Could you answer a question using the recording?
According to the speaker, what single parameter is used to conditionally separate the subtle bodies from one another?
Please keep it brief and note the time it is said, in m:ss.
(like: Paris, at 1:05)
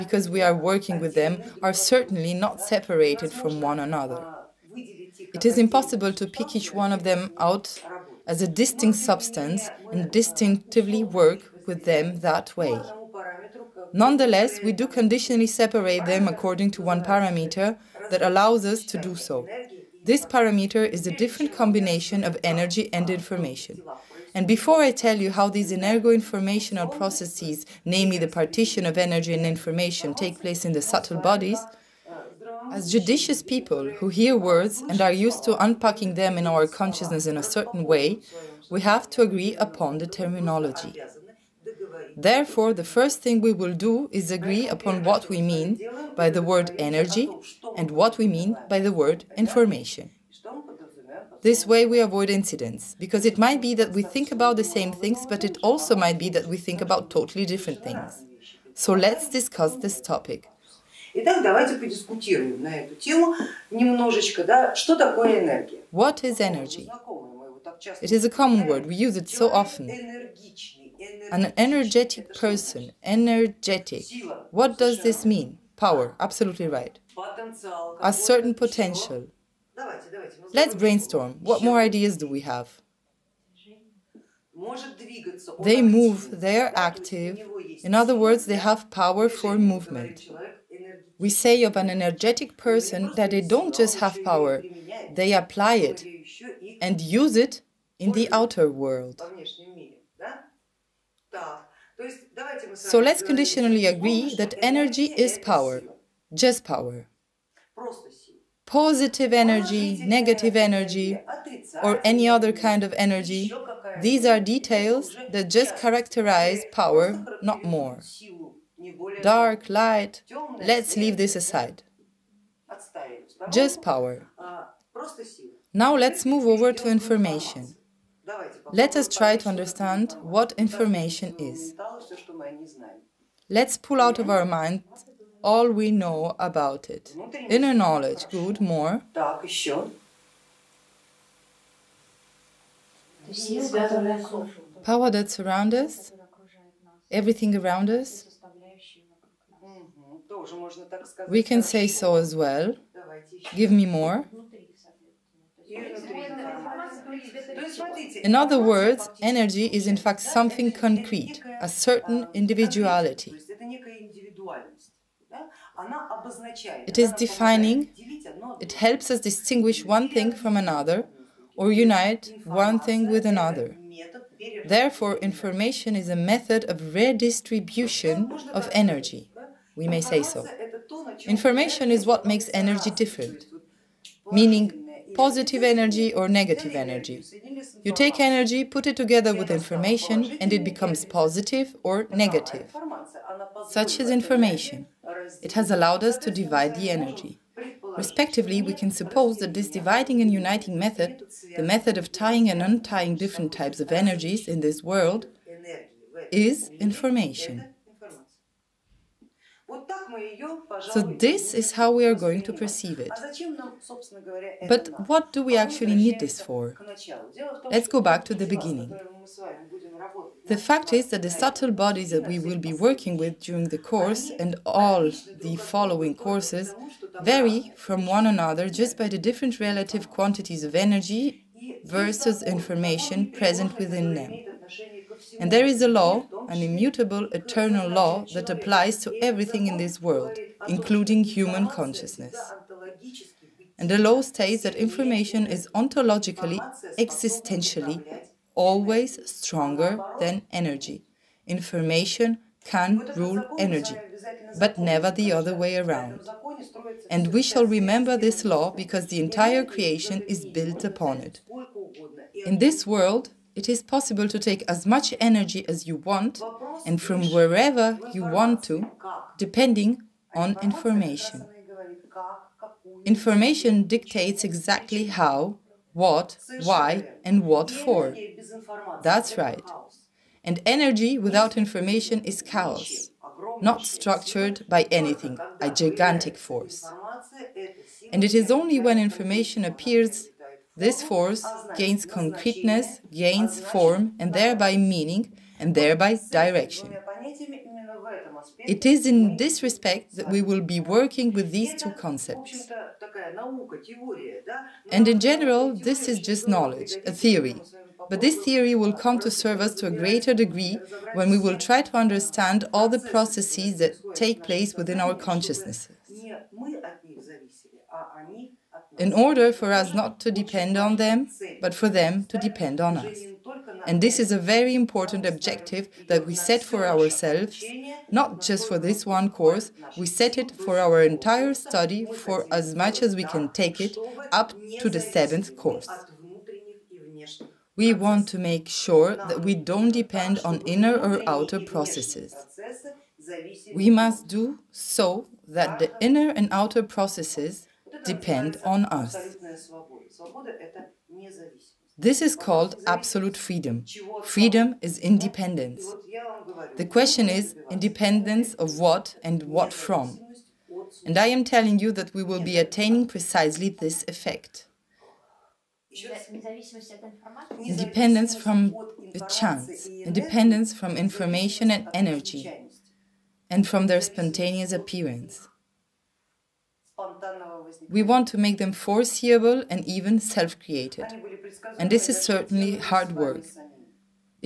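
Combination of energy and information, at 0:21.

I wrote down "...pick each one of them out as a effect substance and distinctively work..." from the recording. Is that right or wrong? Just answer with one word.
wrong.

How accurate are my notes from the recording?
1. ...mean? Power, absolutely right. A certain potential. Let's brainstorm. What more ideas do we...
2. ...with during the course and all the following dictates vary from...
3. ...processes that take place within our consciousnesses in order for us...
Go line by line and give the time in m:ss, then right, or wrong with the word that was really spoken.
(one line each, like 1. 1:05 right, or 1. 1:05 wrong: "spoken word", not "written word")
1. 1:15 right
2. 3:43 wrong: "courses", not "dictates"
3. 5:12 right.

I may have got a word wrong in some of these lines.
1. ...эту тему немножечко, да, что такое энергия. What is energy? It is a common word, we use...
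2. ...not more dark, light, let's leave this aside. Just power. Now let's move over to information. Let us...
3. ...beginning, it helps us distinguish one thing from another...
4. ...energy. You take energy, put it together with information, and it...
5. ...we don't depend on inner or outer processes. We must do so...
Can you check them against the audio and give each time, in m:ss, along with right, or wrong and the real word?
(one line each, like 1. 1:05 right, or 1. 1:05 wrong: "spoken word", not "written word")
1. 1:02 right
2. 1:57 right
3. 2:47 wrong: "defining", not "beginning"
4. 3:06 right
5. 5:39 right.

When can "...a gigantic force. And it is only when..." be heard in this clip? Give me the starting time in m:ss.
4:45.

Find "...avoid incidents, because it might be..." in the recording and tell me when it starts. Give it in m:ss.
0:52.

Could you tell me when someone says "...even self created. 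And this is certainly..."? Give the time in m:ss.
6:19.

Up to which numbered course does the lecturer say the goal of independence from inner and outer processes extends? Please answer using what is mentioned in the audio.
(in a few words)
7th course.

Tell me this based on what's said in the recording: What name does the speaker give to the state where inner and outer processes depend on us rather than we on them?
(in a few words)
Absolute freedom.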